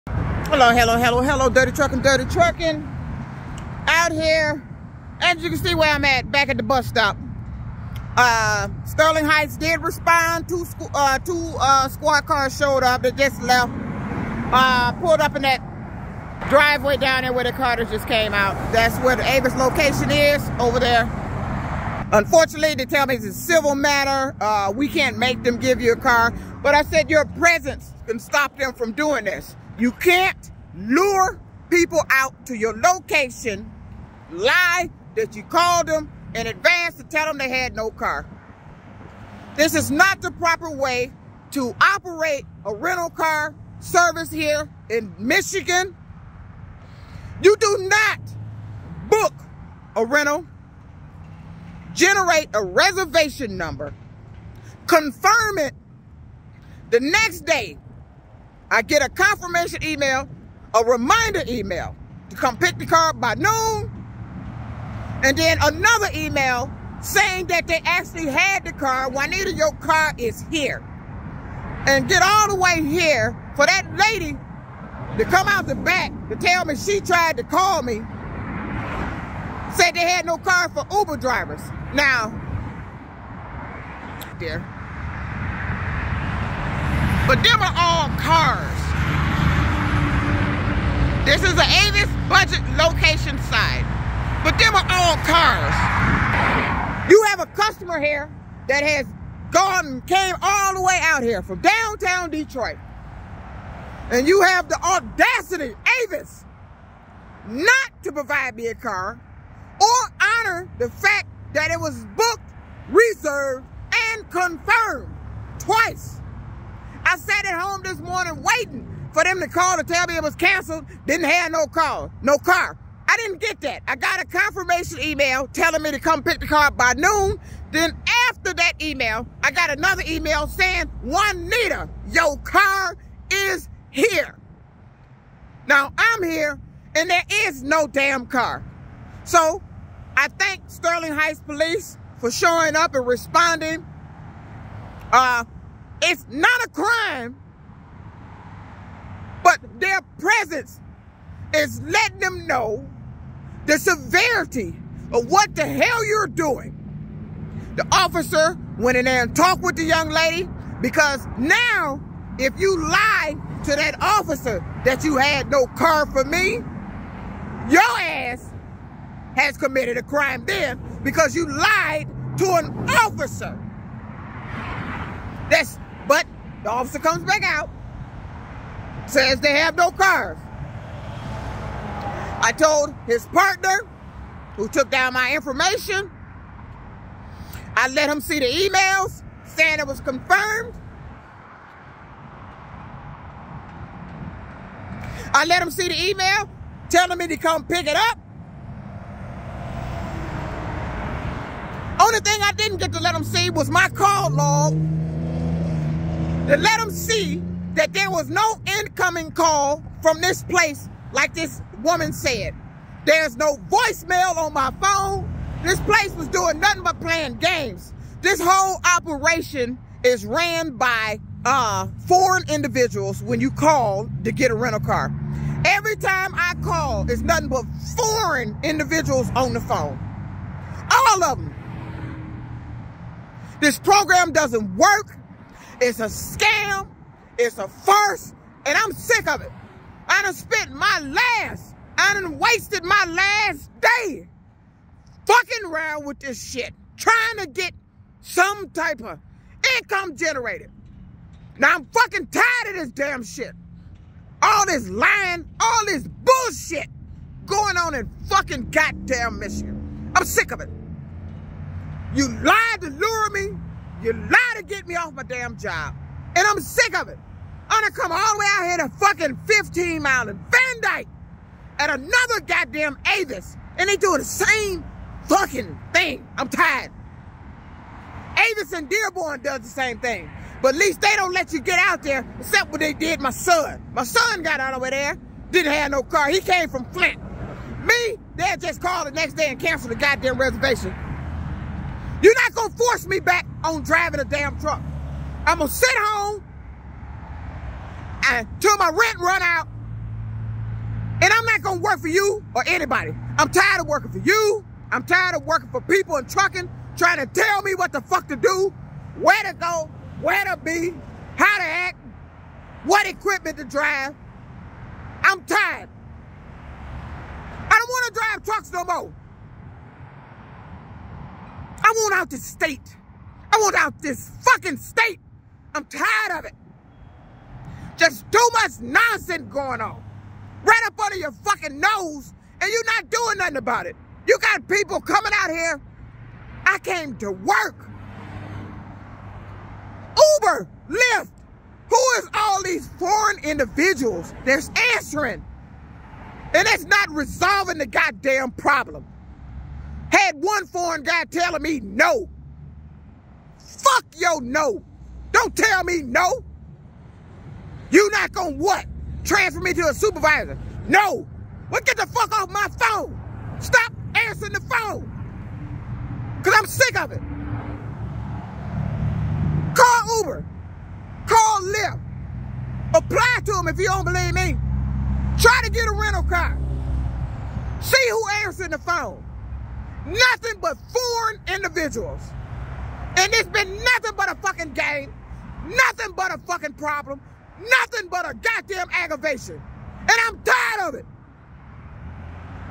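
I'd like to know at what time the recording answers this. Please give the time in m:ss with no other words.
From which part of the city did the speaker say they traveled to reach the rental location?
1:41.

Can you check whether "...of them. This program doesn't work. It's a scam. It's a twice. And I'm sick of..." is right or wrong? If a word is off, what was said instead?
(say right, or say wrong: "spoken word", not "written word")
wrong: "farce", not "twice".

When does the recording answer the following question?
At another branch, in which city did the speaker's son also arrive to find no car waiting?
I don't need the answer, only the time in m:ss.
4:38.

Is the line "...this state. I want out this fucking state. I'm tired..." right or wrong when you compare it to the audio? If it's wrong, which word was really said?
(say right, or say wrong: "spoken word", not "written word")
right.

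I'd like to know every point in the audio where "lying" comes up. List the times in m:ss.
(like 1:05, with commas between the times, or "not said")
4:14.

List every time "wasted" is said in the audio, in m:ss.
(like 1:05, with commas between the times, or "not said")
4:02.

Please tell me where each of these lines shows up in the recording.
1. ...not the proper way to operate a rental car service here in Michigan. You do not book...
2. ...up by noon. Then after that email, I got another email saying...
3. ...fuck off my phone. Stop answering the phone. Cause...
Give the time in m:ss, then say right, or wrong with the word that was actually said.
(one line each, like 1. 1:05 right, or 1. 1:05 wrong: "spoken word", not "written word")
1. 0:39 right
2. 2:06 right
3. 6:02 right.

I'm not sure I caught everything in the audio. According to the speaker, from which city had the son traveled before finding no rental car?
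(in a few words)
Flint.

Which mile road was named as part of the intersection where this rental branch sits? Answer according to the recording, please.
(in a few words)
15 Mile.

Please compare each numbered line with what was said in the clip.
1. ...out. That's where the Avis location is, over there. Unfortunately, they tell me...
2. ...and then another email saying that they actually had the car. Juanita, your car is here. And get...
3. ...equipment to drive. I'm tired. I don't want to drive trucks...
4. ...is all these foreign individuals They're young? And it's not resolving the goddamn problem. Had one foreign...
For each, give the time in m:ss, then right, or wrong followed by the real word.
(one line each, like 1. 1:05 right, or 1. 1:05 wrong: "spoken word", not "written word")
1. 0:18 right
2. 1:05 right
3. 5:13 right
4. 5:42 wrong: "answering", not "young".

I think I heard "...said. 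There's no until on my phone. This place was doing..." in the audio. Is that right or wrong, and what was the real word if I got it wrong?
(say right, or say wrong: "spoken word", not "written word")
wrong: "voicemail", not "until".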